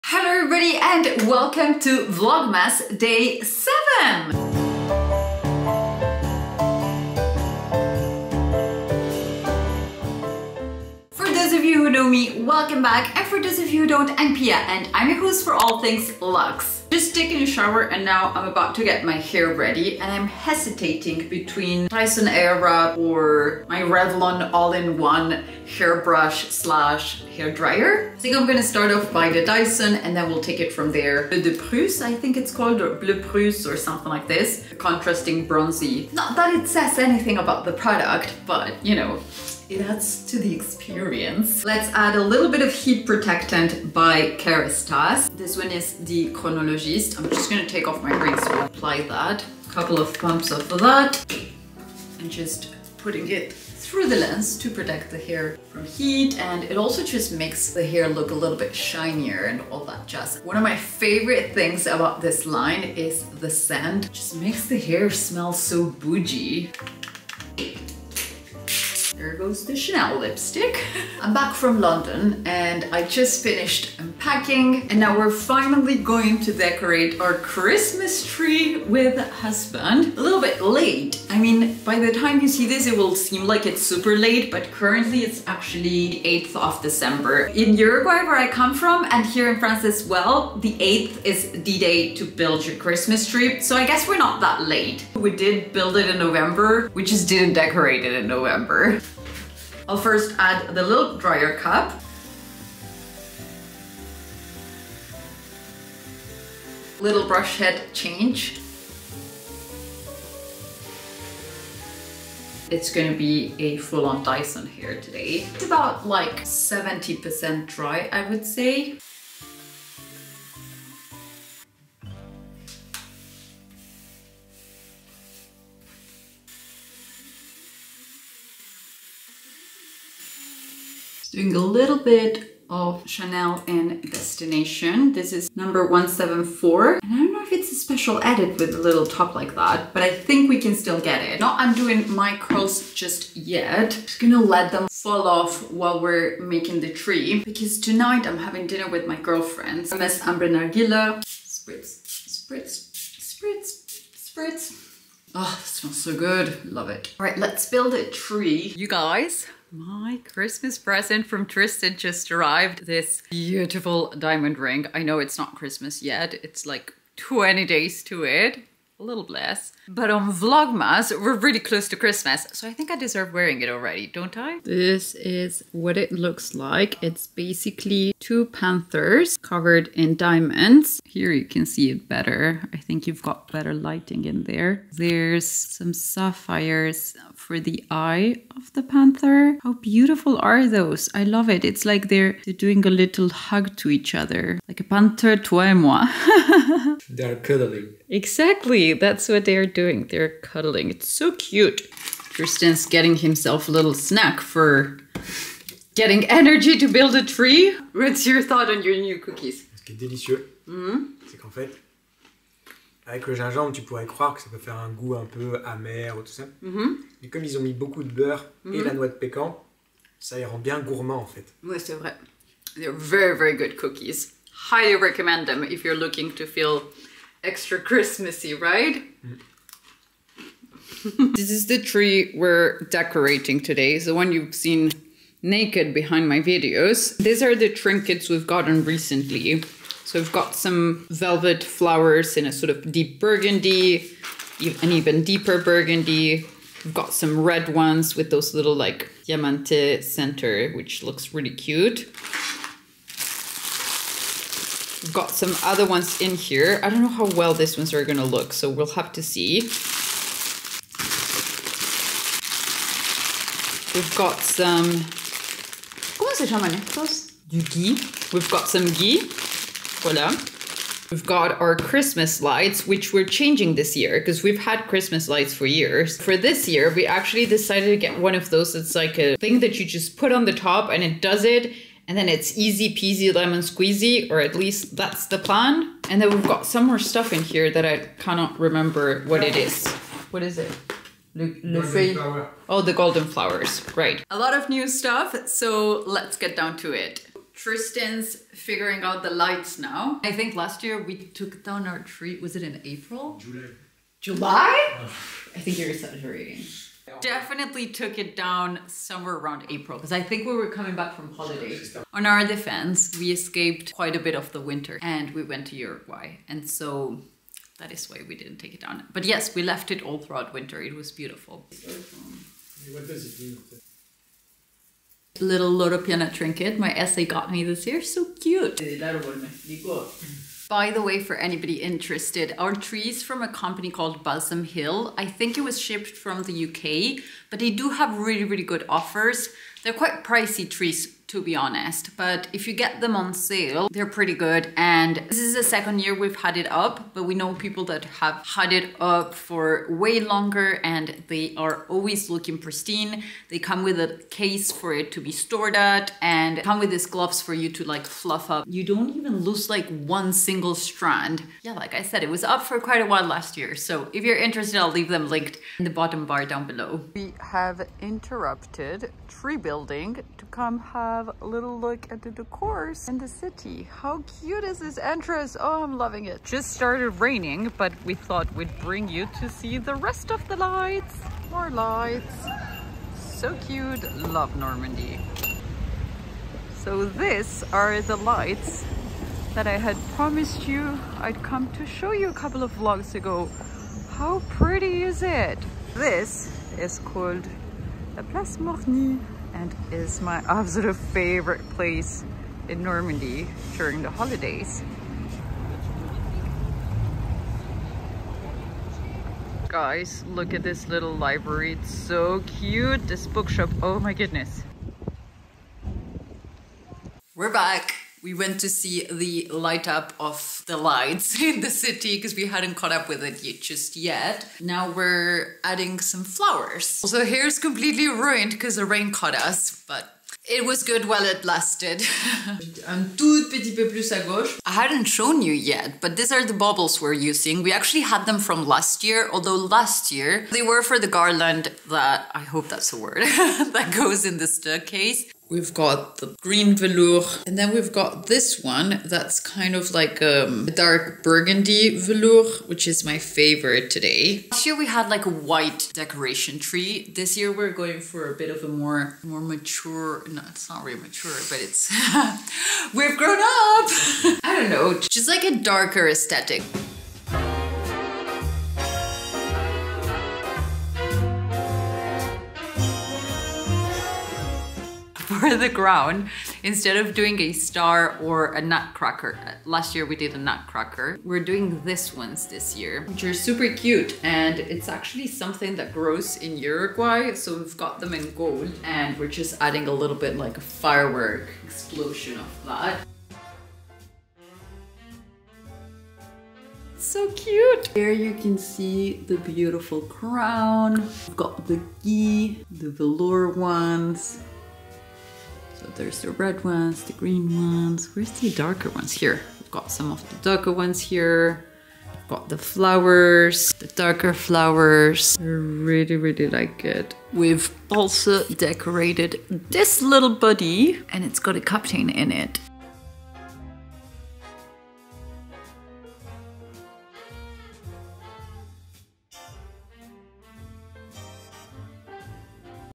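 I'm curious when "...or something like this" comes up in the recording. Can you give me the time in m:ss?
0:33.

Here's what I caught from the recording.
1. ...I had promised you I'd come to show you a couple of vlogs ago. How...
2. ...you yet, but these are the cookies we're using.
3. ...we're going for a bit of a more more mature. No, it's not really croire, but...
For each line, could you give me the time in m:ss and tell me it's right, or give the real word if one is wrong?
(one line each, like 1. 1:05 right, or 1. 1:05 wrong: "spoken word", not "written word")
1. 6:29 right
2. 7:15 wrong: "bubbles", not "cookies"
3. 7:37 wrong: "mature", not "croire".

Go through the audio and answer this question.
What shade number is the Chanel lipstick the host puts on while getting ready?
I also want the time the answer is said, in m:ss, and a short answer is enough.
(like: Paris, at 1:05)
174, at 2:15.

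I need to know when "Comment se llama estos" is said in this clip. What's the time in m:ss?
4:26.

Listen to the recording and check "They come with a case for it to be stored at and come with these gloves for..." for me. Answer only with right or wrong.
right.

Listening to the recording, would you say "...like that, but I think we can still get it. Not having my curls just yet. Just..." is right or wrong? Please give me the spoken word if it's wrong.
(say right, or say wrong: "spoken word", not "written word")
wrong: "undoing", not "having".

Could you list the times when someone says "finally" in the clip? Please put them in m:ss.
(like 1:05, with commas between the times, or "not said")
1:15.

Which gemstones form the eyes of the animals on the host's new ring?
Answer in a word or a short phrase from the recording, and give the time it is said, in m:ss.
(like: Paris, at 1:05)
Sapphires, at 3:05.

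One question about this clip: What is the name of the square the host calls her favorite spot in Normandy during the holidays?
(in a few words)
Place Morny.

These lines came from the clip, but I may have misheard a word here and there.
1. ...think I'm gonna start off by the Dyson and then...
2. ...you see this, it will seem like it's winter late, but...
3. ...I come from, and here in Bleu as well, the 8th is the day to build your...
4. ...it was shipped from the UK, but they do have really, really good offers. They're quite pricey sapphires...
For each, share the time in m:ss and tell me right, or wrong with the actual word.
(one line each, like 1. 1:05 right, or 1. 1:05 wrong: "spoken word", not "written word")
1. 0:28 right
2. 1:22 wrong: "super", not "winter"
3. 1:28 wrong: "France", not "Bleu"
4. 5:35 wrong: "trees", not "sapphires".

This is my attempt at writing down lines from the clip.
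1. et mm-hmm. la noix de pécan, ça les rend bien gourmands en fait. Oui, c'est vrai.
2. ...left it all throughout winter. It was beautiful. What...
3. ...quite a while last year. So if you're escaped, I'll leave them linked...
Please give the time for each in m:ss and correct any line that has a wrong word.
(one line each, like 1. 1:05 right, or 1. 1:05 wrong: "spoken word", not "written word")
1. 3:38 right
2. 5:19 right
3. 6:02 wrong: "interested", not "escaped".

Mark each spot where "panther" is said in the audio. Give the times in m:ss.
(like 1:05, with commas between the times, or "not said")
2:58, 3:08, 3:14.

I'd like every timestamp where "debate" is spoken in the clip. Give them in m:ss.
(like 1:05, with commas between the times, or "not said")
not said.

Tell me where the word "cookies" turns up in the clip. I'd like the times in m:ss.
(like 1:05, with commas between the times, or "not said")
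3:29, 3:43.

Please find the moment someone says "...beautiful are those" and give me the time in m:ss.
3:09.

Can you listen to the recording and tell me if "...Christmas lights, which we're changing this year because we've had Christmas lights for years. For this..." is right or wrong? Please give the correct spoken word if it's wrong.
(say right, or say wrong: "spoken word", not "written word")
right.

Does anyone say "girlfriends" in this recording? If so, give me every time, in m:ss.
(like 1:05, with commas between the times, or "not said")
2:29.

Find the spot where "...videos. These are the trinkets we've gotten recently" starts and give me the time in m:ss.
3:56.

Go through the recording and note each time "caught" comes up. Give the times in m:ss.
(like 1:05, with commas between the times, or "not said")
7:02, 7:09.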